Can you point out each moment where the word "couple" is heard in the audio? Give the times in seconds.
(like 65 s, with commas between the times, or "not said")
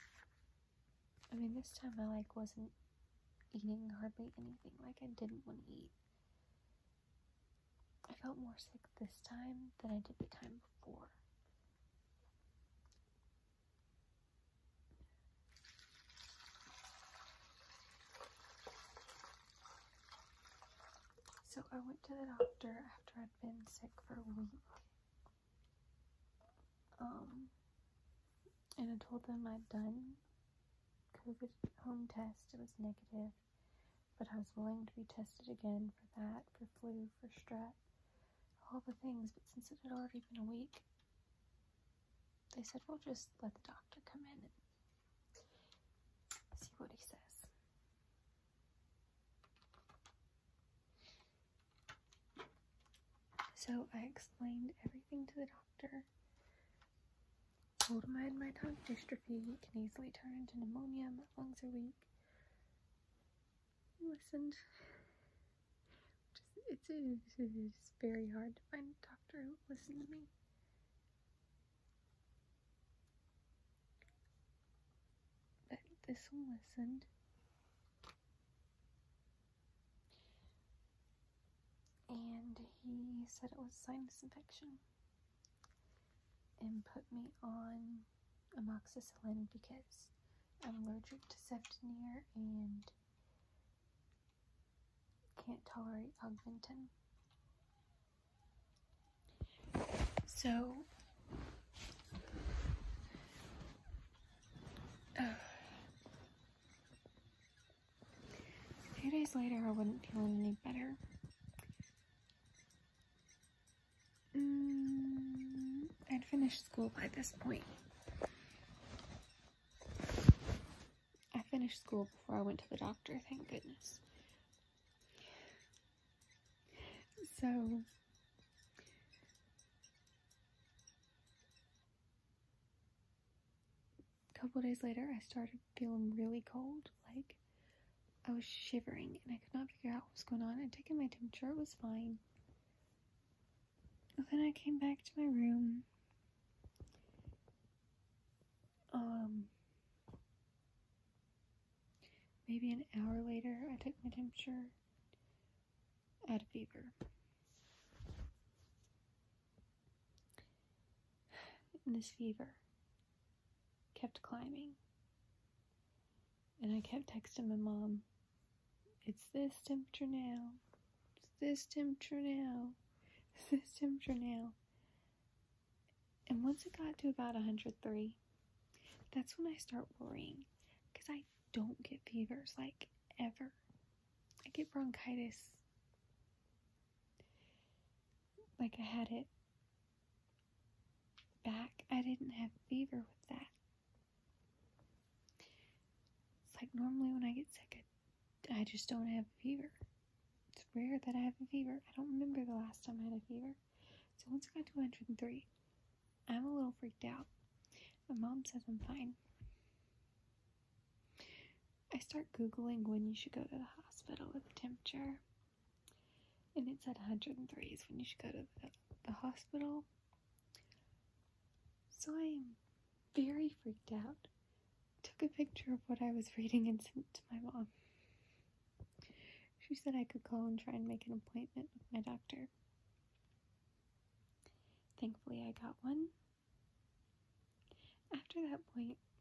134 s.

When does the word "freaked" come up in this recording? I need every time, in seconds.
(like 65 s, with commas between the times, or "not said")
206 s, 223 s.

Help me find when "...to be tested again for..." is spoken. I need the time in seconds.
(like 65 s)
34 s.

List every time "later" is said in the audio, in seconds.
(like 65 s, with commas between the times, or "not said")
109 s, 134 s, 153 s.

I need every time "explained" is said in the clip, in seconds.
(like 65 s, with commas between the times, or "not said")
54 s.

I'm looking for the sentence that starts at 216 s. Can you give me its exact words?
And it said 103 is when you should go to the, the hospital.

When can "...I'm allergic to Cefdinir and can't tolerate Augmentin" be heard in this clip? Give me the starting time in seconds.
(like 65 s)
90 s.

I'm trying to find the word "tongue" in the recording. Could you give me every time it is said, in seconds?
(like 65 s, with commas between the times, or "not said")
58 s.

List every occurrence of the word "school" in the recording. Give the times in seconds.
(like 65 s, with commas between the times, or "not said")
116 s, 121 s.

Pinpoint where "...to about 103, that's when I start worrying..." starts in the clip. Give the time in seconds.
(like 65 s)
176 s.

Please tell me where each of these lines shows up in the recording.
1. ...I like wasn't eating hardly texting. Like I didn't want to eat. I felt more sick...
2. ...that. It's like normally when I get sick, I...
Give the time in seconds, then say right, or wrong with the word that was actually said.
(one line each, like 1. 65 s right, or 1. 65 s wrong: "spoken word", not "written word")
1. 2 s wrong: "anything", not "texting"
2. 193 s right.